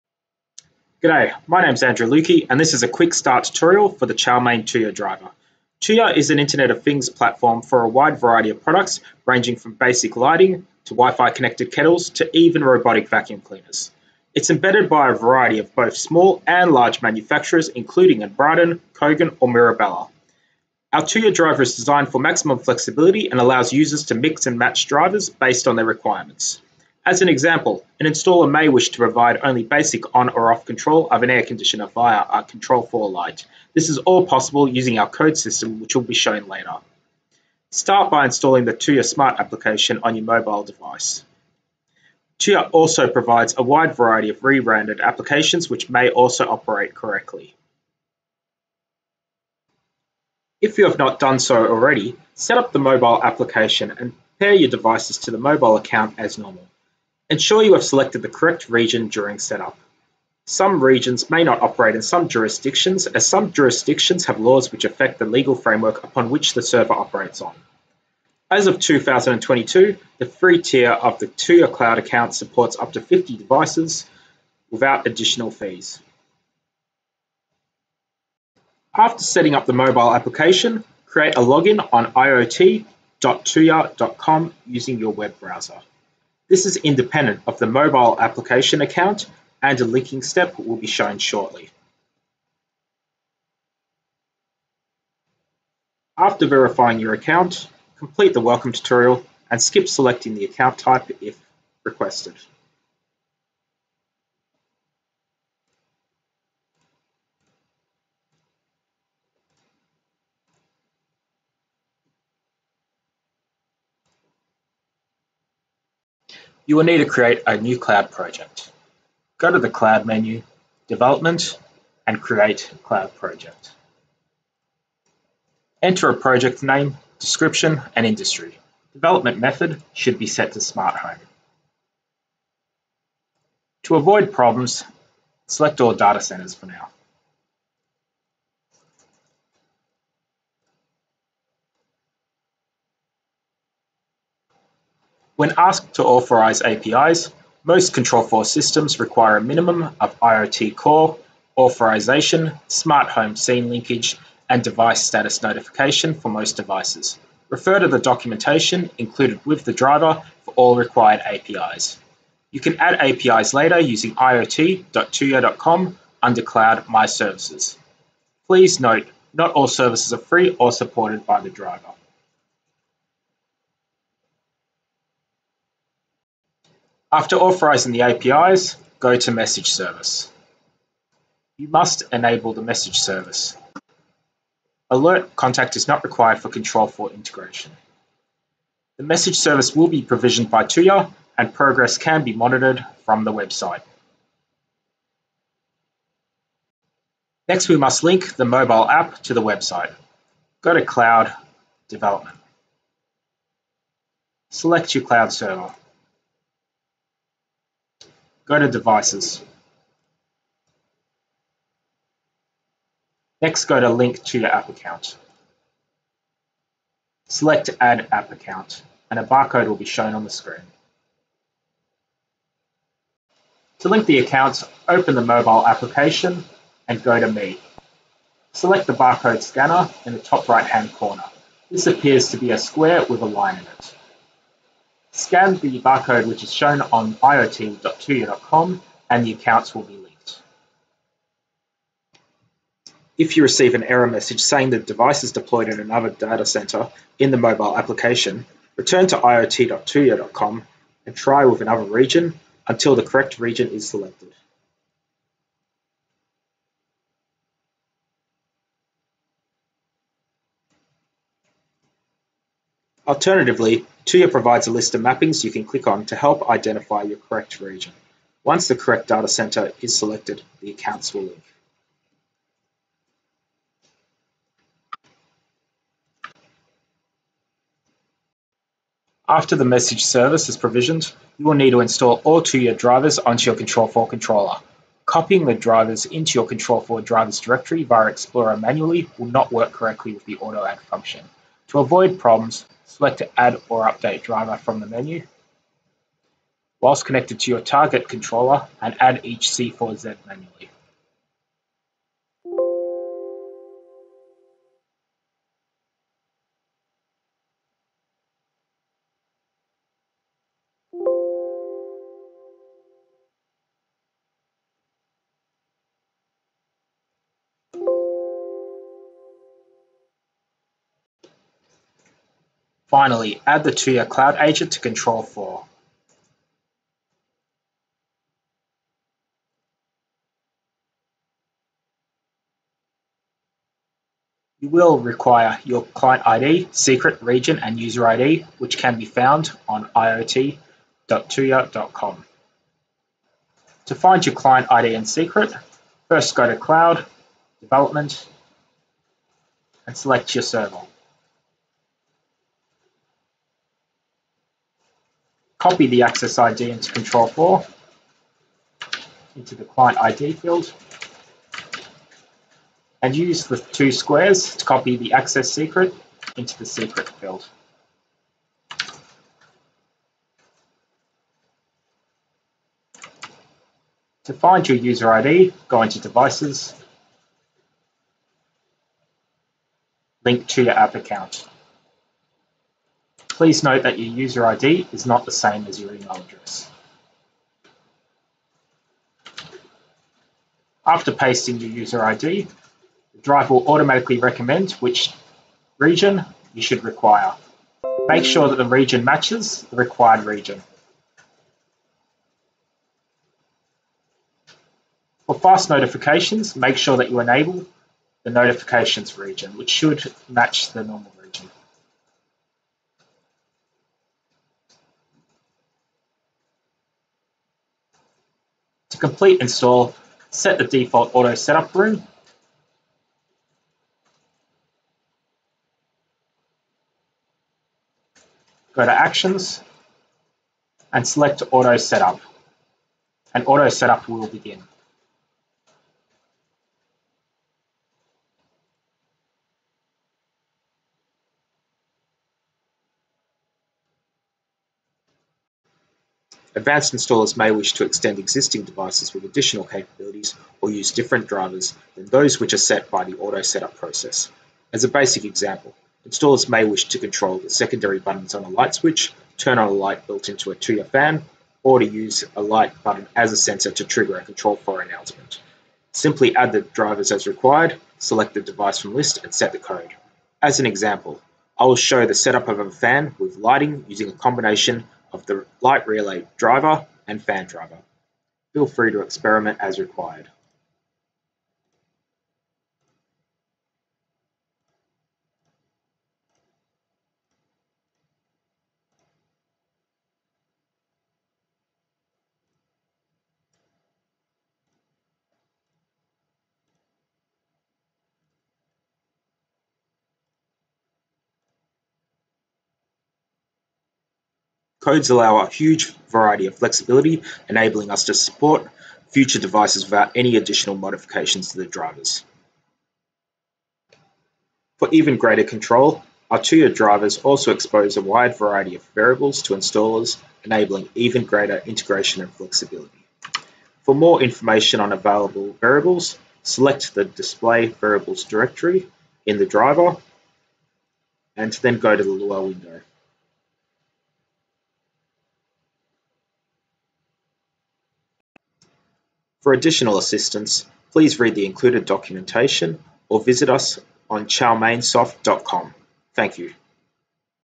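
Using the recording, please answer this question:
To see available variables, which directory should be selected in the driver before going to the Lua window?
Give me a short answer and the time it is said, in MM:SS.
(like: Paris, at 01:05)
Display Variables, at 08:47.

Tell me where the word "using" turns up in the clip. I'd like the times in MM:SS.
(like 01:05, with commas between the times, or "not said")
00:34, 01:24, 02:43, 07:53.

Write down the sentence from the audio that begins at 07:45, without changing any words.
Simply add the drivers as required, select the device from list, and set the code.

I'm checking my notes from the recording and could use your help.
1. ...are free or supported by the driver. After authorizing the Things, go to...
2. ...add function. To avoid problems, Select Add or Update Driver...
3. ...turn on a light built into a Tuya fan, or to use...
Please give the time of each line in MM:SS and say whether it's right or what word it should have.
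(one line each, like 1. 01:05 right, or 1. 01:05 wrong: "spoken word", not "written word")
1. 02:50 wrong: "APIs", not "Things"
2. 04:50 right
3. 07:39 right.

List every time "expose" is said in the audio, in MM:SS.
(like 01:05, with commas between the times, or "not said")
08:37.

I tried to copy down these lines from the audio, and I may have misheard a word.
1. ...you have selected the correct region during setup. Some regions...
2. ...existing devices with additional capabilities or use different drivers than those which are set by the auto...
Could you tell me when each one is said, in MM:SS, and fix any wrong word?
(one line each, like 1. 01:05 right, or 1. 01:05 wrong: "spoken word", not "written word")
1. 00:57 right
2. 07:28 right.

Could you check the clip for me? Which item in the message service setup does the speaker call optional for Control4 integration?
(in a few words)
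Alert contact.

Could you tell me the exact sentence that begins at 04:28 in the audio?
Once the correct data center is selected, the accounts will link.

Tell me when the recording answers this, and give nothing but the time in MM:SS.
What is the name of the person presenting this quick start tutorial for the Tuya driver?
00:01.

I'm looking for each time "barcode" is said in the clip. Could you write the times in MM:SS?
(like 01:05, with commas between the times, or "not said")
03:39, 03:48, 03:55.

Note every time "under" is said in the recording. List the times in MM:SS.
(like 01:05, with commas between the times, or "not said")
02:46.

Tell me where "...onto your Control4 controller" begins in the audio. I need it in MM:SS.
04:43.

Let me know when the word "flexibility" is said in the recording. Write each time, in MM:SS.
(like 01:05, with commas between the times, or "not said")
00:22, 08:26, 08:42.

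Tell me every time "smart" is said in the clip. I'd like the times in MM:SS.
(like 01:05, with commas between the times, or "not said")
00:39, 02:10, 02:32.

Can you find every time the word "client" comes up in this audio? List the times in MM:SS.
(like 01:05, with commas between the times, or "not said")
05:35, 05:44, 05:59.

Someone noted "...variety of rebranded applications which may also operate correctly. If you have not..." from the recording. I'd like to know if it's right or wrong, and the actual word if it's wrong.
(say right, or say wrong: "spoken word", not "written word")
right.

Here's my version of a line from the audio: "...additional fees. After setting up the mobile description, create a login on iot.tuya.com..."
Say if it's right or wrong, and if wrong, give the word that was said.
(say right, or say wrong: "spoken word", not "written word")
wrong: "application", not "description".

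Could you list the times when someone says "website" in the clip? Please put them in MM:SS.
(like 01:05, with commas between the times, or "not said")
03:13, 03:19.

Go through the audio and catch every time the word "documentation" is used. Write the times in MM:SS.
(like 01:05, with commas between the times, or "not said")
02:37, 09:01.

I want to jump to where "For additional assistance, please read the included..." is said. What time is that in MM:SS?
08:59.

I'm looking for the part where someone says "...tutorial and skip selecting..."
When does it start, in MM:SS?
01:38.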